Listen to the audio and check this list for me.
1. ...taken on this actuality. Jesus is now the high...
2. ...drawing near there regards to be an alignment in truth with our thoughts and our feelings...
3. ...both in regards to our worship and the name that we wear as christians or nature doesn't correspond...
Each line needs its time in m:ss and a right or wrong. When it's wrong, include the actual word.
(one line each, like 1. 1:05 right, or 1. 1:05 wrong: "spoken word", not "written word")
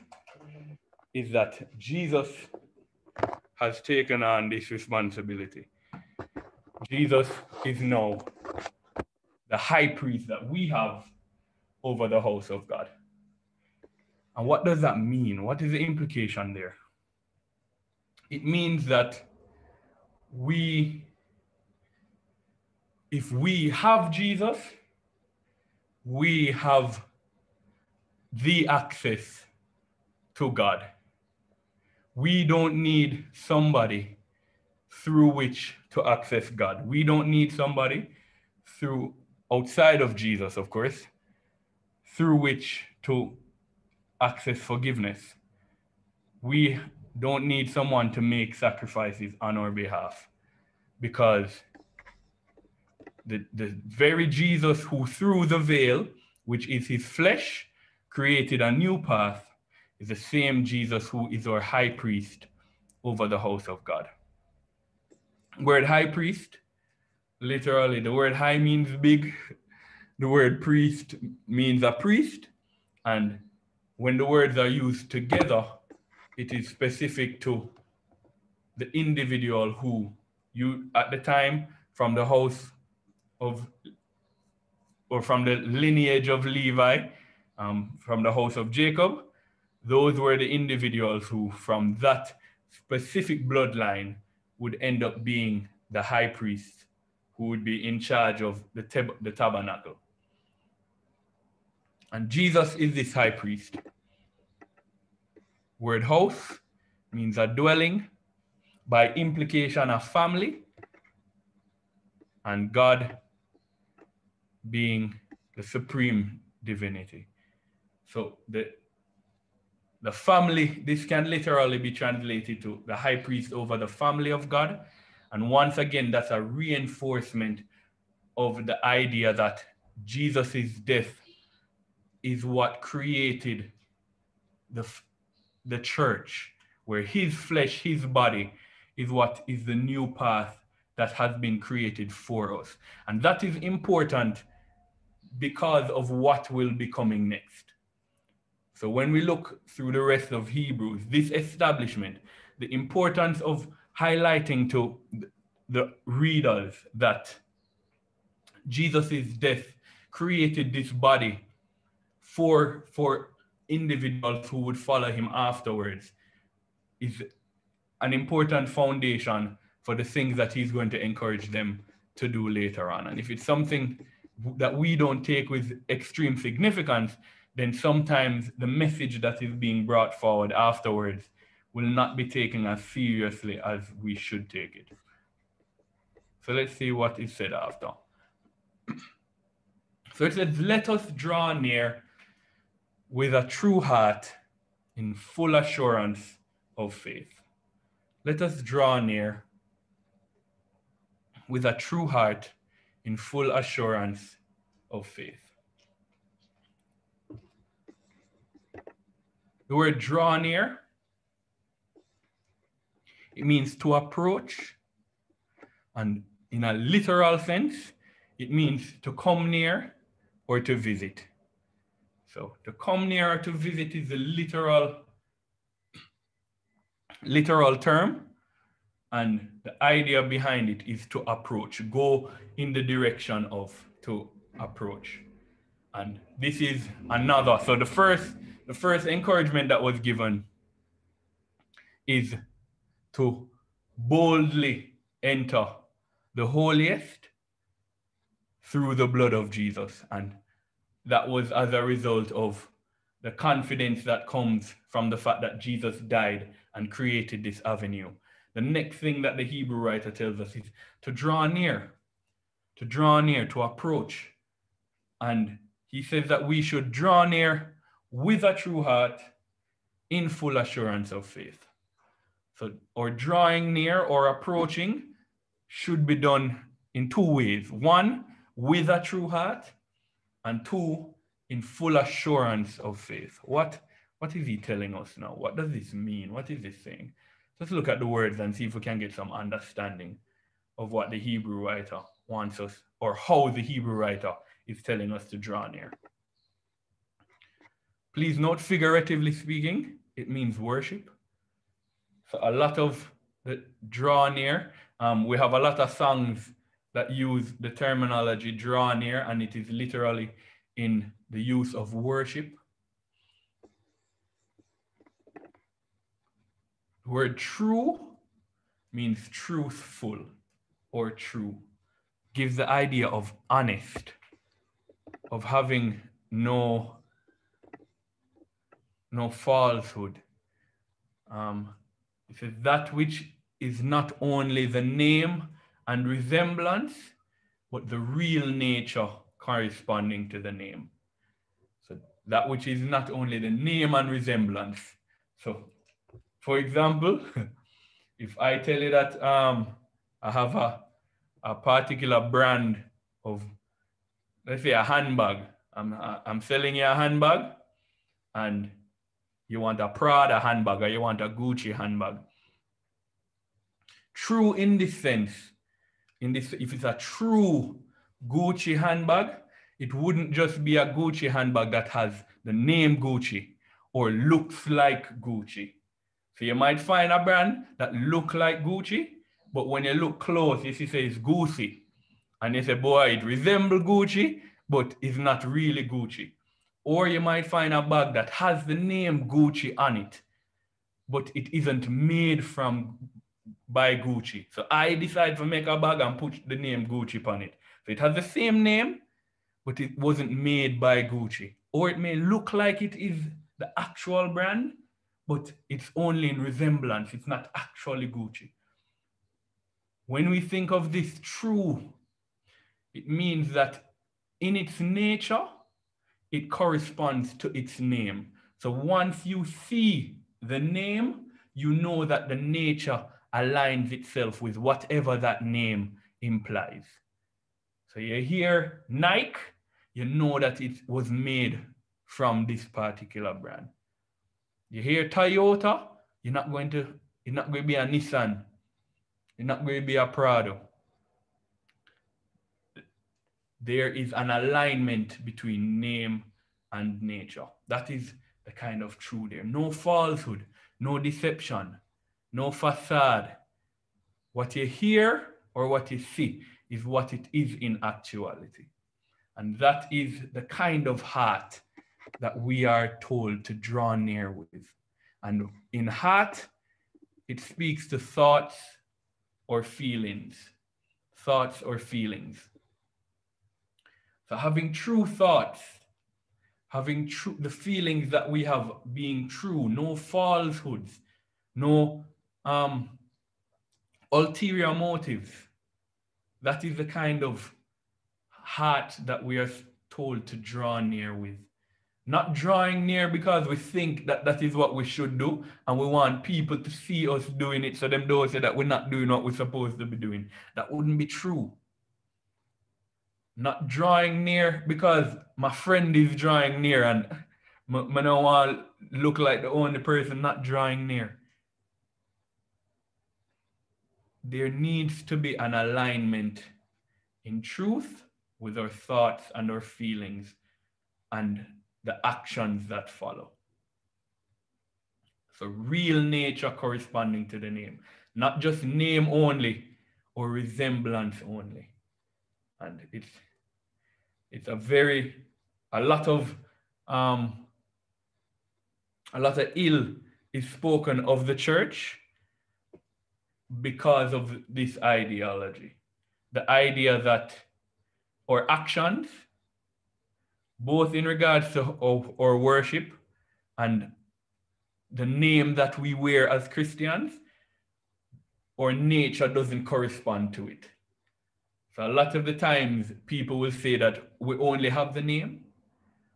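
1. 0:03 wrong: "responsibility", not "actuality"
2. 8:30 wrong: "needs", not "regards"
3. 9:10 right.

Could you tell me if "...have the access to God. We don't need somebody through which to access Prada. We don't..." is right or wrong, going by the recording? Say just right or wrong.
wrong.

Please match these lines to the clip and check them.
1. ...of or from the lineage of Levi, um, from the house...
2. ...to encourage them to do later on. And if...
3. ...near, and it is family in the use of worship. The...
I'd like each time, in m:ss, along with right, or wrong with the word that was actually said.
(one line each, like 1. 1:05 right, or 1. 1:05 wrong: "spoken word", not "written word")
1. 1:23 right
2. 2:50 right
3. 5:08 wrong: "literally", not "family".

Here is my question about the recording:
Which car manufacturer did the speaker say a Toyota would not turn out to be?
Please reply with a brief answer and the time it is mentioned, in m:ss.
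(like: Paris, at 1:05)
Nissan, at 7:17.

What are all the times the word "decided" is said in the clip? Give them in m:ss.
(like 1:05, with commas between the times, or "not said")
6:34.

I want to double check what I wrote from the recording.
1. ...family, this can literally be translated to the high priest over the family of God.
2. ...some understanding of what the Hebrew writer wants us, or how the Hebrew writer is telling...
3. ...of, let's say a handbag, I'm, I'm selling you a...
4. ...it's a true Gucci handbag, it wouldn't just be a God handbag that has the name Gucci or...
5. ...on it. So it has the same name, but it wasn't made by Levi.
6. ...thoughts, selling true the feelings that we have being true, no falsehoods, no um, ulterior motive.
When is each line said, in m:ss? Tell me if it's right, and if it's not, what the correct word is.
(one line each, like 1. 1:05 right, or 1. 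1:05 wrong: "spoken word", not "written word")
1. 2:00 right
2. 4:49 right
3. 5:53 right
4. 6:06 wrong: "Gucci", not "God"
5. 6:37 wrong: "Gucci", not "Levi"
6. 7:55 wrong: "having", not "selling".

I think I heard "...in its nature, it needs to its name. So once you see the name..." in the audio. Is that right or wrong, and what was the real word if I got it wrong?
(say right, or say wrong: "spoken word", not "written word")
wrong: "corresponds", not "needs".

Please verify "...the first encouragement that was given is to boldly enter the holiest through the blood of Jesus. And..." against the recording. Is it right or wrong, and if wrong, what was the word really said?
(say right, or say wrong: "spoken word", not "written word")
right.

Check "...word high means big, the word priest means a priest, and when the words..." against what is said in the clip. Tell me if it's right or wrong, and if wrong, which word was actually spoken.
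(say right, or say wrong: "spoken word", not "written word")
right.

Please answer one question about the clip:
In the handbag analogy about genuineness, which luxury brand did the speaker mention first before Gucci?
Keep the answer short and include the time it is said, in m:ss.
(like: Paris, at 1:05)
Prada, at 5:59.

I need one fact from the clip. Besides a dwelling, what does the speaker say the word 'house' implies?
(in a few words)
A family.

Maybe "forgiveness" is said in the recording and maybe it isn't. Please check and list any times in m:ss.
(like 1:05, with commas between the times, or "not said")
0:44.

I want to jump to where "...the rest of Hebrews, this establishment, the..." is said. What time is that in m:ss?
2:29.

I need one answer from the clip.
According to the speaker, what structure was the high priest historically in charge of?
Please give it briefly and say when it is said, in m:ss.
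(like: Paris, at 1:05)
The tabernacle, at 1:39.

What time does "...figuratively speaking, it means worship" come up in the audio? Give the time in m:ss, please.
4:58.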